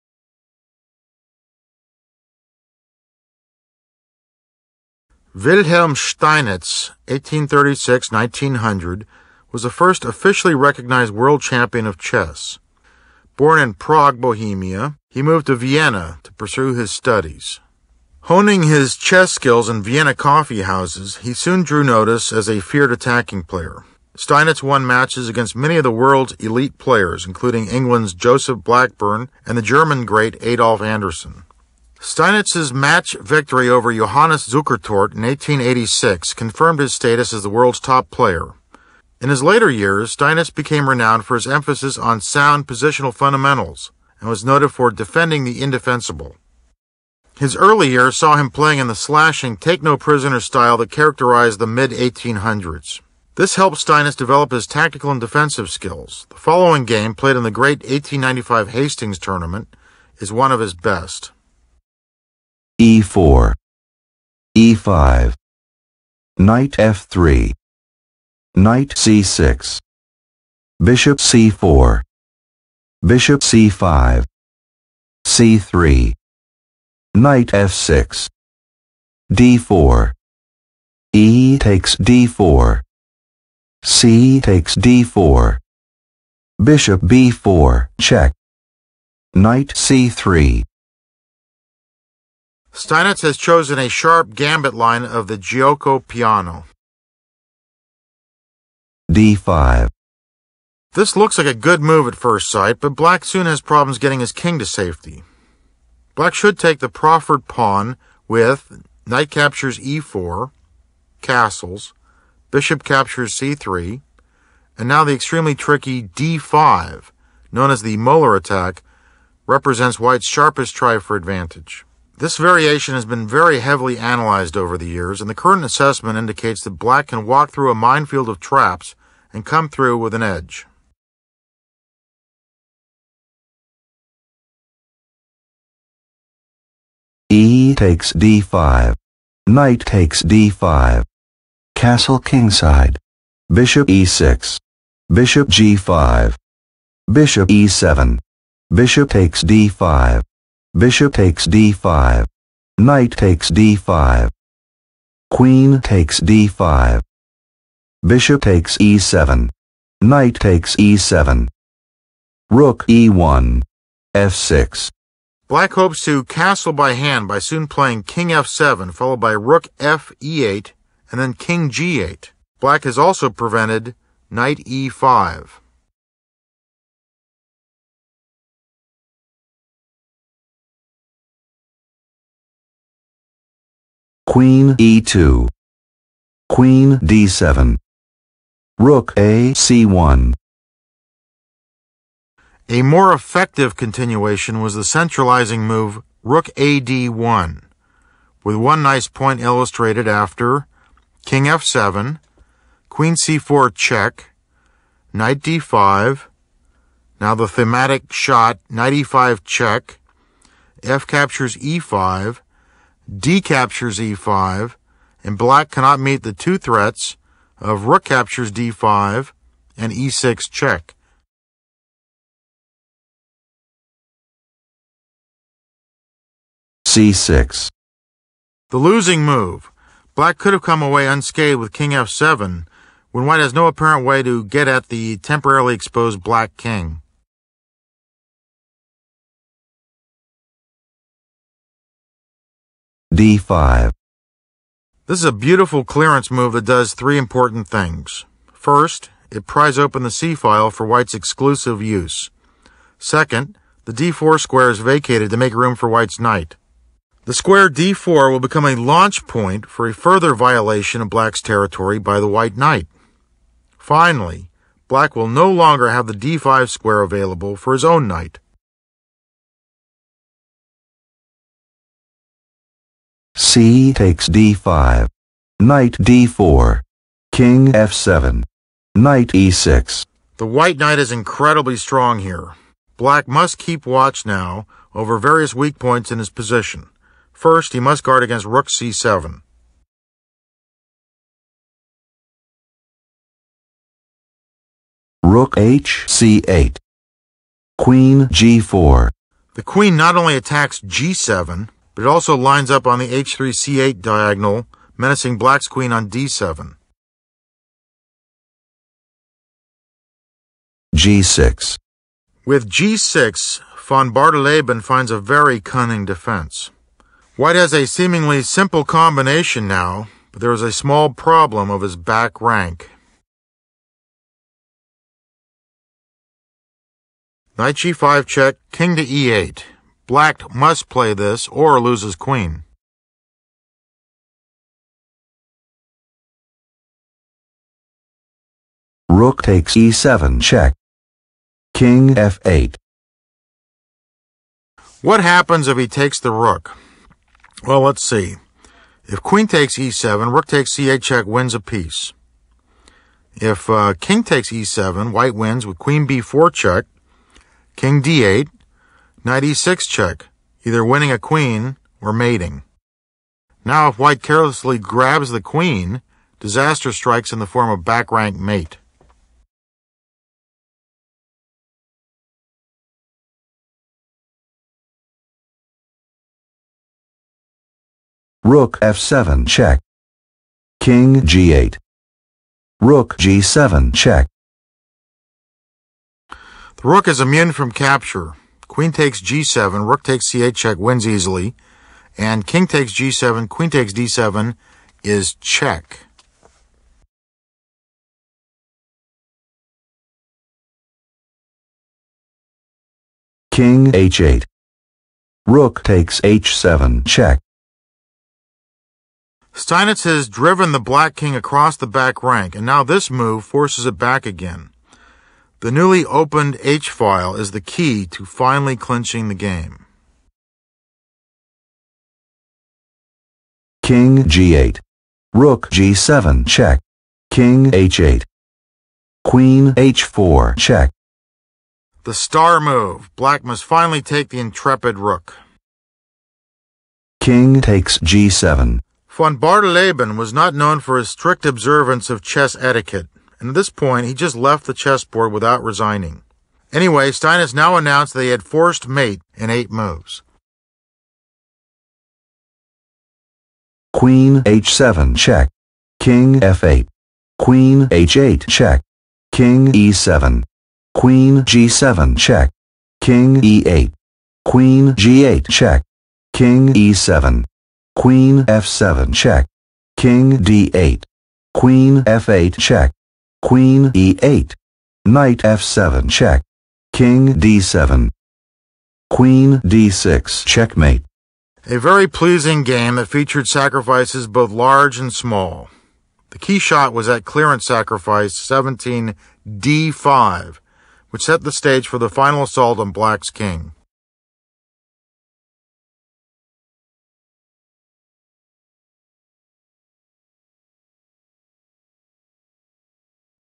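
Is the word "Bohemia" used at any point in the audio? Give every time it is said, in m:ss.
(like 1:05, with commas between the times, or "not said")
0:14.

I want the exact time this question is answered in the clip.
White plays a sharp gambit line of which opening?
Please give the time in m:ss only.
1:35.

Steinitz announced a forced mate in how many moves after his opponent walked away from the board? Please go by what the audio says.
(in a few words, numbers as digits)
8.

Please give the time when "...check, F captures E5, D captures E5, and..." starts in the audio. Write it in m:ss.
3:29.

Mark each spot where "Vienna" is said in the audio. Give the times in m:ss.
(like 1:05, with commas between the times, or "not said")
0:15, 0:19.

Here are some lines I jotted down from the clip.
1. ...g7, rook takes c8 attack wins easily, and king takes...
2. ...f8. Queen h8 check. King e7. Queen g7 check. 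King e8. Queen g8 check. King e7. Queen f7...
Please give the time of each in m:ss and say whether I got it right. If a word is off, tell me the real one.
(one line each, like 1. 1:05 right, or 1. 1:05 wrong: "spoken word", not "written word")
1. 6:29 wrong: "check", not "attack"
2. 7:36 right.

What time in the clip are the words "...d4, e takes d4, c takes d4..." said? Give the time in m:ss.
1:19.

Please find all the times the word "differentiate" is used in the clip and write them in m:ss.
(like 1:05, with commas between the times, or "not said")
not said.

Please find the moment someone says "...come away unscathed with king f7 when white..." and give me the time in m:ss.
3:50.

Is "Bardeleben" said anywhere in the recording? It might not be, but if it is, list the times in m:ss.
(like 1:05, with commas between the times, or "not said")
5:14, 7:19.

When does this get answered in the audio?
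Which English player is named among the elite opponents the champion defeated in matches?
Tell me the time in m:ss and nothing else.
0:28.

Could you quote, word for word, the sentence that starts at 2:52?
Black has also prevented knight e5.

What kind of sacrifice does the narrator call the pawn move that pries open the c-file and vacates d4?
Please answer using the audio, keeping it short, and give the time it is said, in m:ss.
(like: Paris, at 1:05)
clearance move, at 4:05.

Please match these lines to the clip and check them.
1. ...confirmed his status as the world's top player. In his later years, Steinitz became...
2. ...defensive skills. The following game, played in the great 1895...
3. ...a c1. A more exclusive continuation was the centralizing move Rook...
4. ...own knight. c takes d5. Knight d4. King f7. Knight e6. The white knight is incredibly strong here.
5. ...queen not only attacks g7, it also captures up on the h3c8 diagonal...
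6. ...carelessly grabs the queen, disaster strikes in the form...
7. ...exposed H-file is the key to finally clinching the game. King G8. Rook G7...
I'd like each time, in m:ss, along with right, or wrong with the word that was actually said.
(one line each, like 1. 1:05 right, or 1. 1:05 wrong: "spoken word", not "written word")
1. 0:36 right
2. 0:55 right
3. 3:09 wrong: "effective", not "exclusive"
4. 4:27 right
5. 4:59 wrong: "lines", not "captures"
6. 6:04 right
7. 6:56 wrong: "opened", not "exposed".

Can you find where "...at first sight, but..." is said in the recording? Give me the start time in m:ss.
1:42.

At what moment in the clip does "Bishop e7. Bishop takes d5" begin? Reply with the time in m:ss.
2:27.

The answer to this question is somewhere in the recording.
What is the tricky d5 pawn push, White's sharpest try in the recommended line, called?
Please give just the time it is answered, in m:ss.
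1:57.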